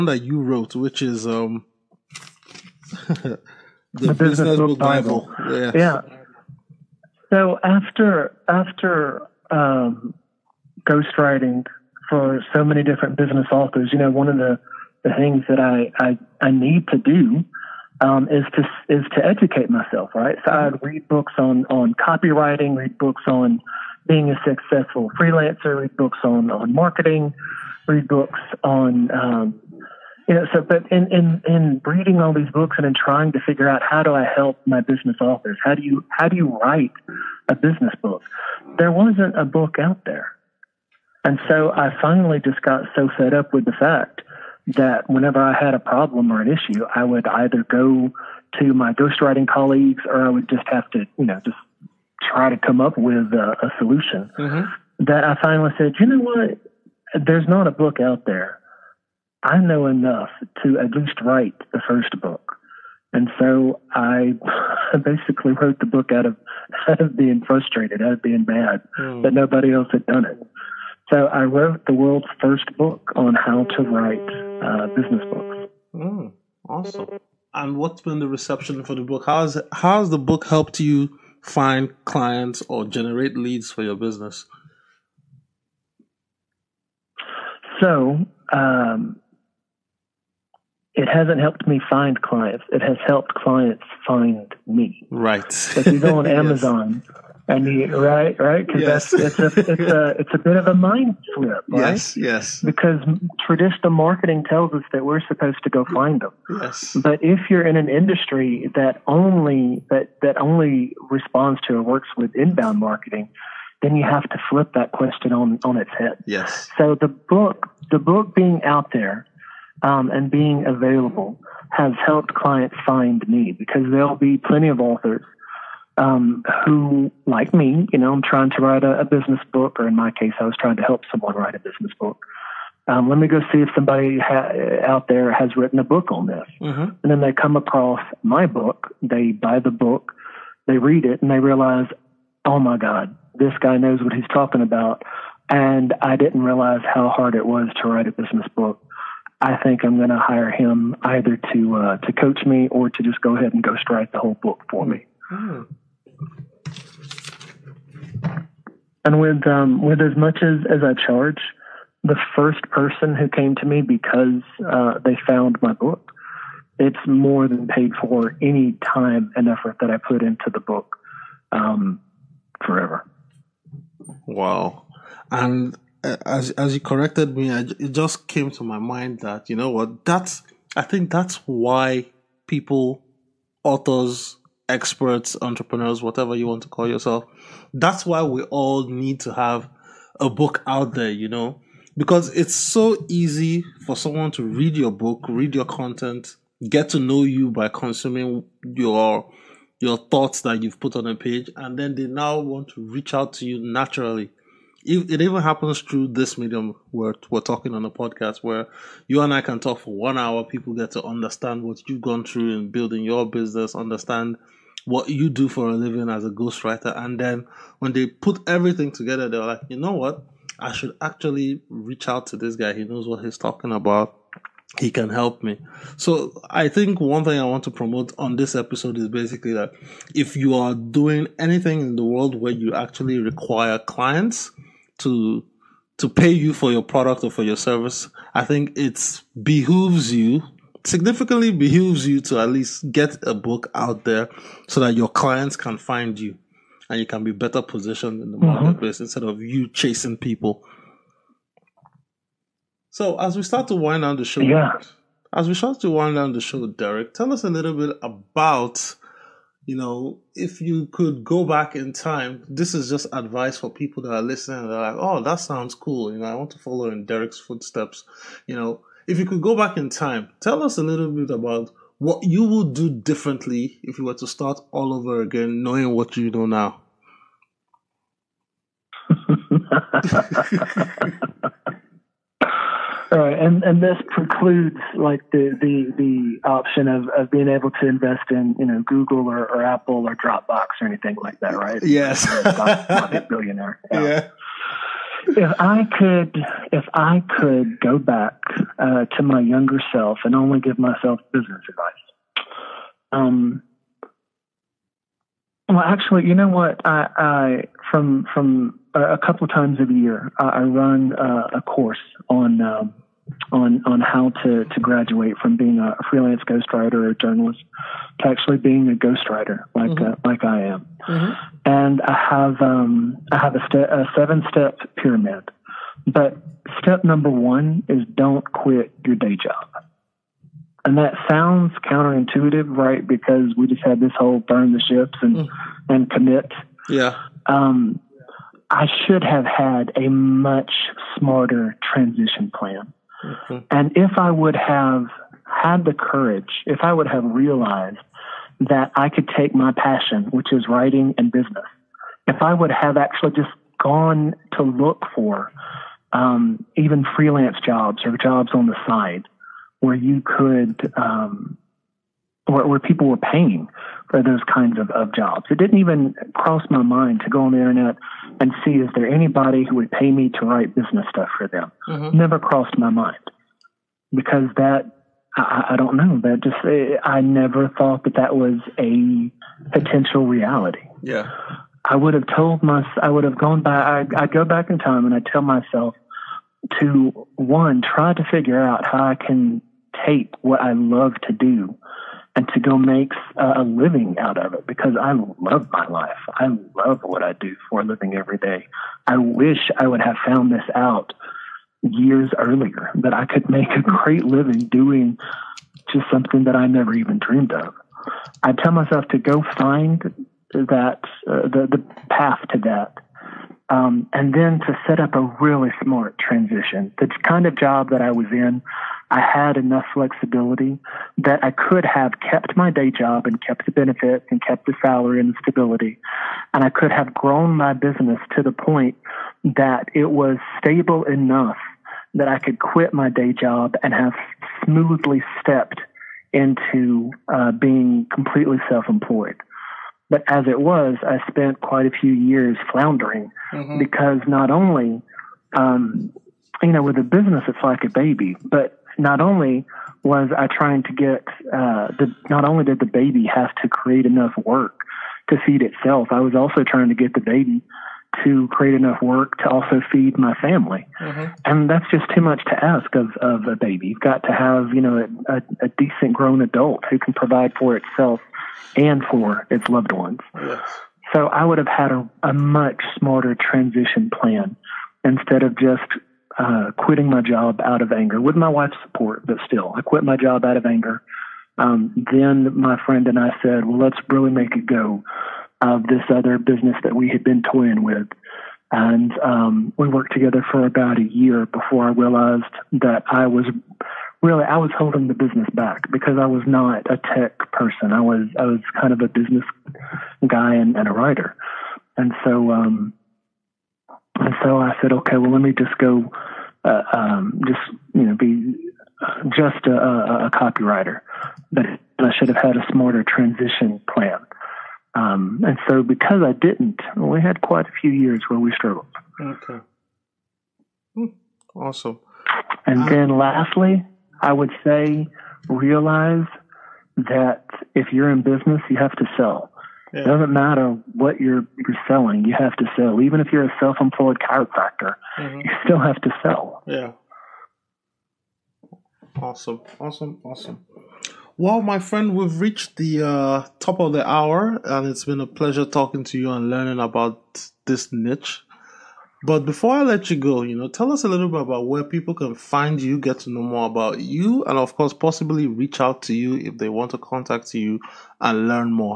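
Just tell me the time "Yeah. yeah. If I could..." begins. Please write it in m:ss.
4:53.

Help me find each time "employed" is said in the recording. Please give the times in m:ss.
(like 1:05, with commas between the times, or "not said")
7:18, 8:53.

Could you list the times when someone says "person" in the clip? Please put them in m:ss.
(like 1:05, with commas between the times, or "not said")
2:42, 8:17.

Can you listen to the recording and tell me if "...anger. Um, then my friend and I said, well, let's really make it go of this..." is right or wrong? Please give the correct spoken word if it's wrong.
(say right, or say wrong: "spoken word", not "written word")
right.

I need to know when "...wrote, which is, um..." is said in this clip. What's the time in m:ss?
0:00.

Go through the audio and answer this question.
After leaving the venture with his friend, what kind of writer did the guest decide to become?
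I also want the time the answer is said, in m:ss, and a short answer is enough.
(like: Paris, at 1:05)
Copywriter, at 8:30.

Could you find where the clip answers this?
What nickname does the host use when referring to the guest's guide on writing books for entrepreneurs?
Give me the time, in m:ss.
0:04.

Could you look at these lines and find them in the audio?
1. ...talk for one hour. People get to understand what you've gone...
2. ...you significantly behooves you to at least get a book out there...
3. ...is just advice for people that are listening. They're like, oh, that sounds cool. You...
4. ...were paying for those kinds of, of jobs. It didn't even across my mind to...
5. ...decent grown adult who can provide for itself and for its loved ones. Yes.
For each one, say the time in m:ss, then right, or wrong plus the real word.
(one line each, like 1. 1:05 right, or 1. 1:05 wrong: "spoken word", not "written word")
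1. 3:29 right
2. 4:00 right
3. 4:22 right
4. 6:03 wrong: "cross", not "across"
5. 7:45 right.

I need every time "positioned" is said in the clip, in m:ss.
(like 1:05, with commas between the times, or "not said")
4:07.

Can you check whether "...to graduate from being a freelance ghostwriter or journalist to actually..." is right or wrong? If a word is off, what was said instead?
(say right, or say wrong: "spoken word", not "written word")
right.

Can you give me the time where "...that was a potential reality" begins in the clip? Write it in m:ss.
6:18.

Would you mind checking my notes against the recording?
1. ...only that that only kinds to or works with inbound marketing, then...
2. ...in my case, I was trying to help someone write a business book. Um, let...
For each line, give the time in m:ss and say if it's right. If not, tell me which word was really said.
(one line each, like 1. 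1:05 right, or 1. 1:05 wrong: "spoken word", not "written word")
1. 1:49 wrong: "responds", not "kinds"
2. 2:09 right.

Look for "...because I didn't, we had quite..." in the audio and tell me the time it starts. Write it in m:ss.
8:35.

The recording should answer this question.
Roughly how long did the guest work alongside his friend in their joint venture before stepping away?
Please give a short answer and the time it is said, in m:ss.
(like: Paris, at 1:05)
About a year, at 8:10.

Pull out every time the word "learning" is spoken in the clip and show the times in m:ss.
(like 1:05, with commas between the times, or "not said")
9:06.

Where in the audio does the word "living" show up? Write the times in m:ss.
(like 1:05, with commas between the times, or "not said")
3:35, 6:33, 6:37, 6:44.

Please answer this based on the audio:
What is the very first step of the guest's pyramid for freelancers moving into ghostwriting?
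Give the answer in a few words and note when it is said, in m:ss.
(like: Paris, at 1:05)
Don't quit your day job, at 5:28.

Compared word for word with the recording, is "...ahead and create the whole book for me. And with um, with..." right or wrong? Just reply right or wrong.
wrong.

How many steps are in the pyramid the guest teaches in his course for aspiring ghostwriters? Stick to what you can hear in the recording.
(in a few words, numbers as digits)
7.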